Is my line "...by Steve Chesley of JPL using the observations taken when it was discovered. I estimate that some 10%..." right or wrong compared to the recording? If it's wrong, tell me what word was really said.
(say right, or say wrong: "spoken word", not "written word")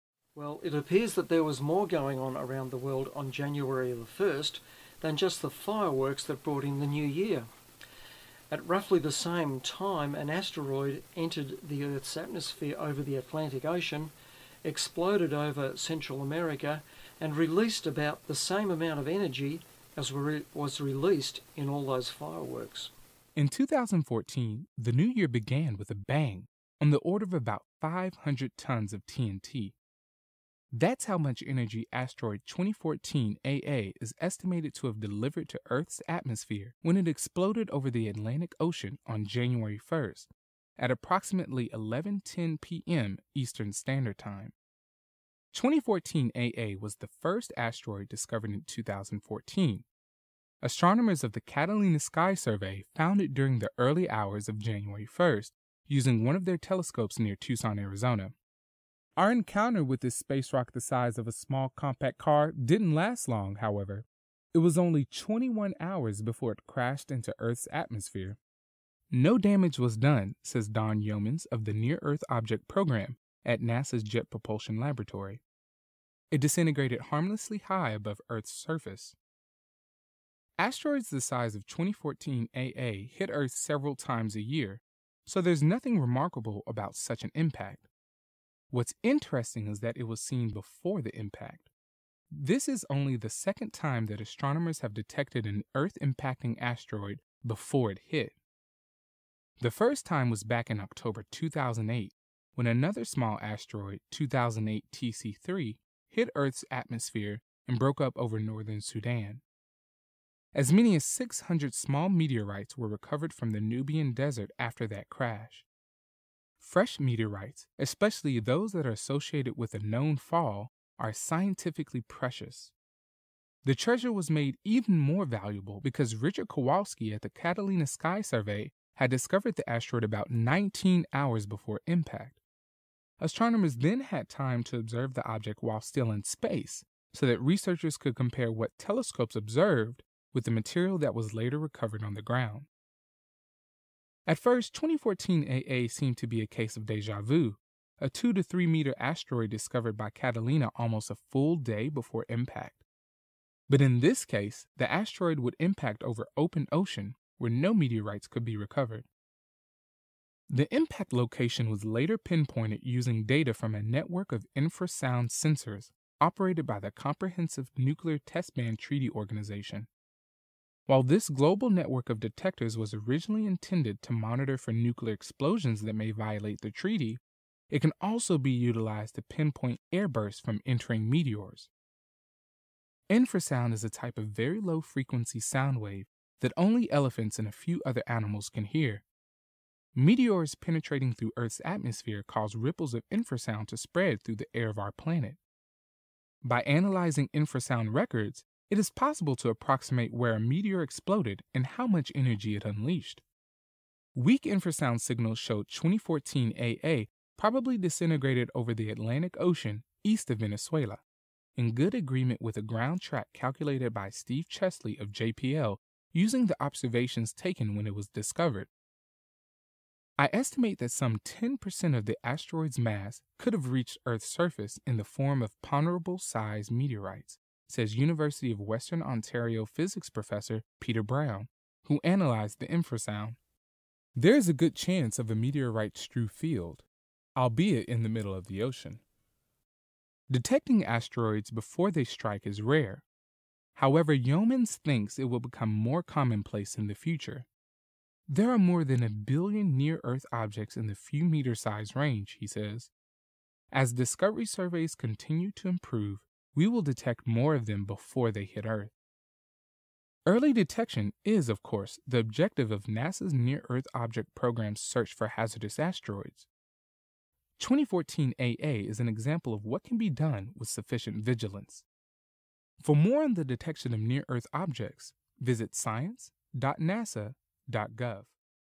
right.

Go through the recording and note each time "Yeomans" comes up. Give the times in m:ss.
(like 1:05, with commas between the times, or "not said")
1:11, 4:04.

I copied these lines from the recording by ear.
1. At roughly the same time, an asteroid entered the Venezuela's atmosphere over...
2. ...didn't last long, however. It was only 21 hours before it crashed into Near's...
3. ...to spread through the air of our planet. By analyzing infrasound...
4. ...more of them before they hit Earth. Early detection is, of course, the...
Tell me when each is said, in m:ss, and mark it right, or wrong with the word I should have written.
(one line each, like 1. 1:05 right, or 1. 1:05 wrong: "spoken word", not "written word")
1. 0:08 wrong: "Earth", not "Venezuela"
2. 1:02 wrong: "Earth", not "Near"
3. 3:13 right
4. 4:17 right.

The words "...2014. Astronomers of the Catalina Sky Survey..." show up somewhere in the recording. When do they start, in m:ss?
0:48.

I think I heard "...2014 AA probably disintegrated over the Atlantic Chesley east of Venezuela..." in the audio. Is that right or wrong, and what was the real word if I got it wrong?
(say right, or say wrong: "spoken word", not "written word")
wrong: "Ocean", not "Chesley".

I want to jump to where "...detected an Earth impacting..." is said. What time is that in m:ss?
1:34.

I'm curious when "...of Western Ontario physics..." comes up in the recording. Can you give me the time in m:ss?
3:48.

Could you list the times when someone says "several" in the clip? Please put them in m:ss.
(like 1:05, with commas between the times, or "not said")
1:23.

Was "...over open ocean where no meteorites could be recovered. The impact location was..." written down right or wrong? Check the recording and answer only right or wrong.
right.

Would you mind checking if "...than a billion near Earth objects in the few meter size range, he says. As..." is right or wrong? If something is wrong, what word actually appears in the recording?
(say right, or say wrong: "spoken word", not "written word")
right.